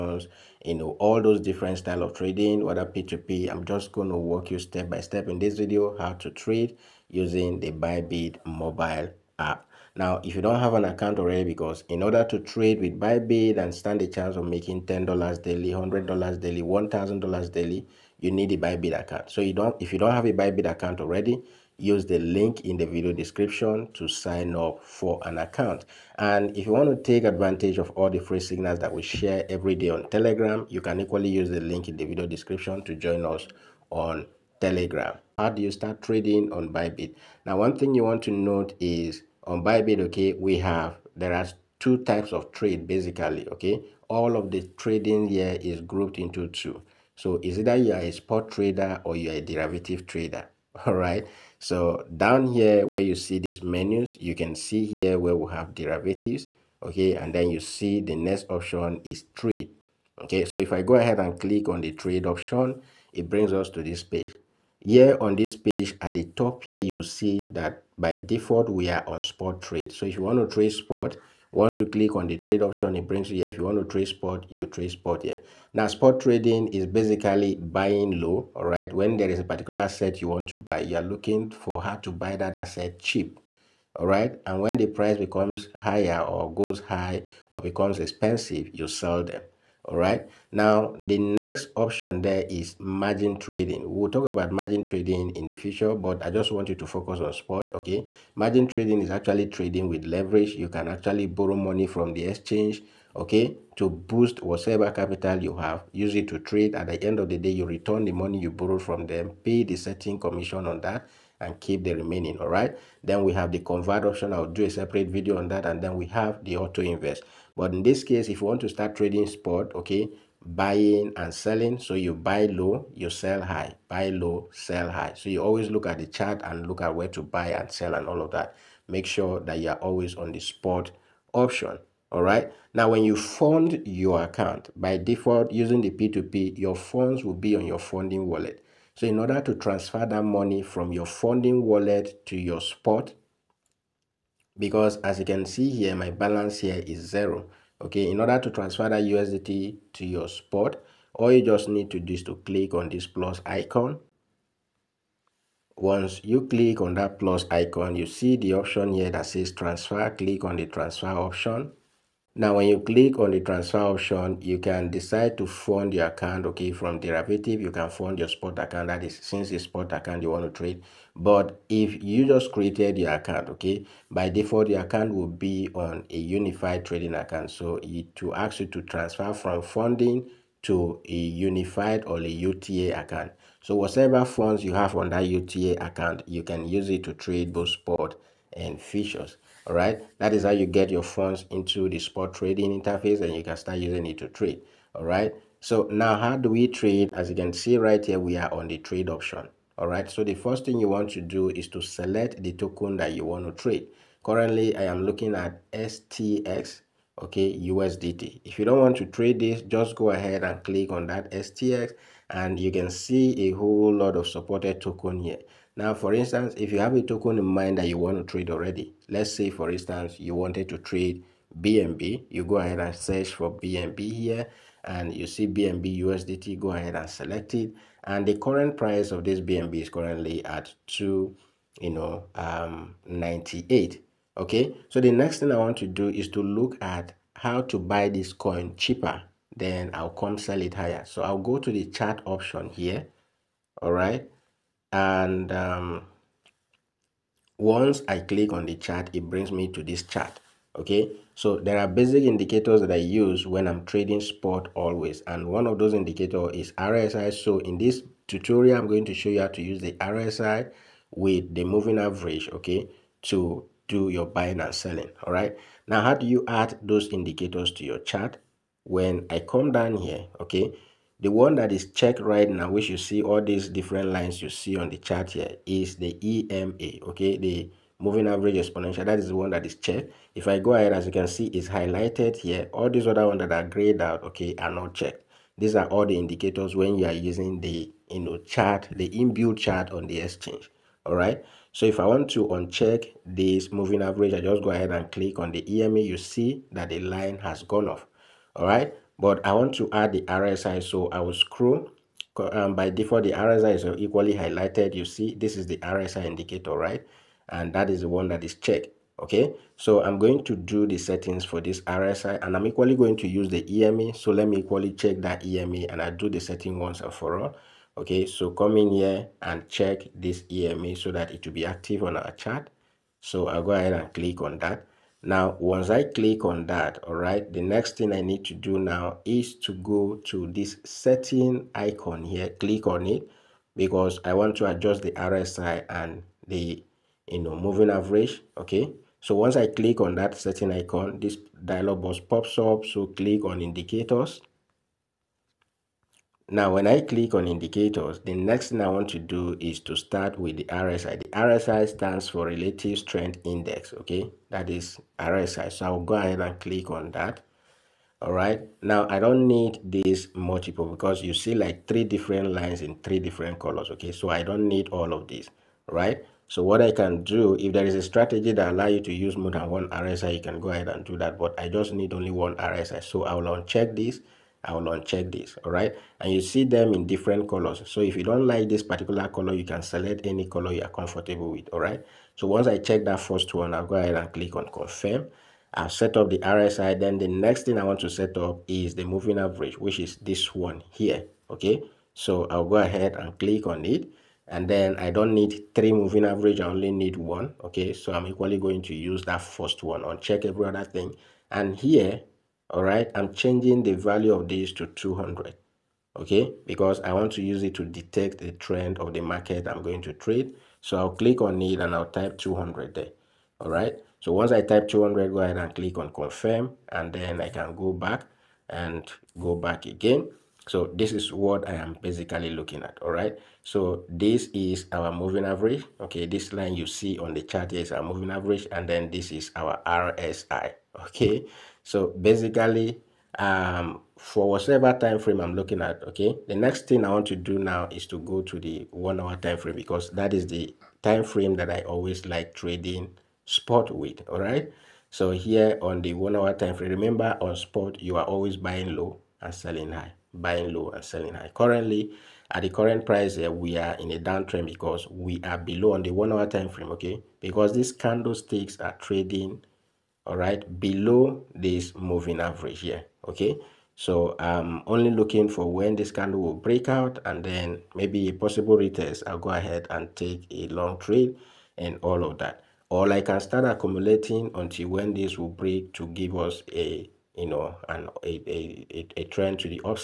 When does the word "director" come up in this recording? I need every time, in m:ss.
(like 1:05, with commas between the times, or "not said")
not said.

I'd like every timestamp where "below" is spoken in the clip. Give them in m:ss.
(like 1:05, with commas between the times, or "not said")
7:35, 7:40.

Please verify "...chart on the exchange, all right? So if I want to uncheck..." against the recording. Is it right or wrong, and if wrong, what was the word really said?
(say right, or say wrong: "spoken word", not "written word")
right.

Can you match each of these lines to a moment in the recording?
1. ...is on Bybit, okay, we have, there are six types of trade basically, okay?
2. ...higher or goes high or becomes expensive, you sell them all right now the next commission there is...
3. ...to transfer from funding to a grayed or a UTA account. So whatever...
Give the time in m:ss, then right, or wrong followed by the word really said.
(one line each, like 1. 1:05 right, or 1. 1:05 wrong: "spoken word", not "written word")
1. 0:38 wrong: "two", not "six"
2. 1:25 wrong: "option", not "commission"
3. 2:58 wrong: "unified", not "grayed".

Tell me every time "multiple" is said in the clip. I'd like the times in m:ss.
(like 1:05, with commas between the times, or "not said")
6:00.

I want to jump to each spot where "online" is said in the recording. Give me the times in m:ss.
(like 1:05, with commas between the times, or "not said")
not said.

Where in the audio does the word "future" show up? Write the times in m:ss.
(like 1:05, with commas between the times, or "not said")
1:35, 3:08.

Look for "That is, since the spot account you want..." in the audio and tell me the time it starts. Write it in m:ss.
2:48.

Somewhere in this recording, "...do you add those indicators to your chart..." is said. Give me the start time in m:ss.
4:26.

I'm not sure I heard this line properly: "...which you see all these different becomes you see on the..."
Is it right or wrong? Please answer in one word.
wrong.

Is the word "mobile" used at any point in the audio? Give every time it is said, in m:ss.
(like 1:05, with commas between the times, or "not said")
0:08.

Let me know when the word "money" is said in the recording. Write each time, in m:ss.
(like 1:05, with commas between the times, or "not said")
1:41, 1:48, 2:20.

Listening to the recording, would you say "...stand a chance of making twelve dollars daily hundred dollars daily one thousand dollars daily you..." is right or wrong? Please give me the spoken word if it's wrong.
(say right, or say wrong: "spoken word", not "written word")
wrong: "ten", not "twelve".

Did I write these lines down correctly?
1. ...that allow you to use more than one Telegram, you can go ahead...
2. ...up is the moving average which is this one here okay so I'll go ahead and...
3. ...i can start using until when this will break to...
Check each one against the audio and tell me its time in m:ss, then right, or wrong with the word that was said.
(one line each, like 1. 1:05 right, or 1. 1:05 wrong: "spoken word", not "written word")
1. 6:08 wrong: "RSI", not "Telegram"
2. 6:28 right
3. 7:53 wrong: "accumulating", not "using".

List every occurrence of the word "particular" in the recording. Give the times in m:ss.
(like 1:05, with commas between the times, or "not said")
1:19, 6:18.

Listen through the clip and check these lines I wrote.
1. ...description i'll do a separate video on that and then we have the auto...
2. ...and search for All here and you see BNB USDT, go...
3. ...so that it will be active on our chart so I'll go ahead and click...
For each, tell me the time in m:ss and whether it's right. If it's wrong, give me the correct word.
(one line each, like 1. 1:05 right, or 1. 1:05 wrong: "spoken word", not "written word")
1. 1:54 wrong: "option", not "description"
2. 3:42 wrong: "BNB", not "All"
3. 5:20 right.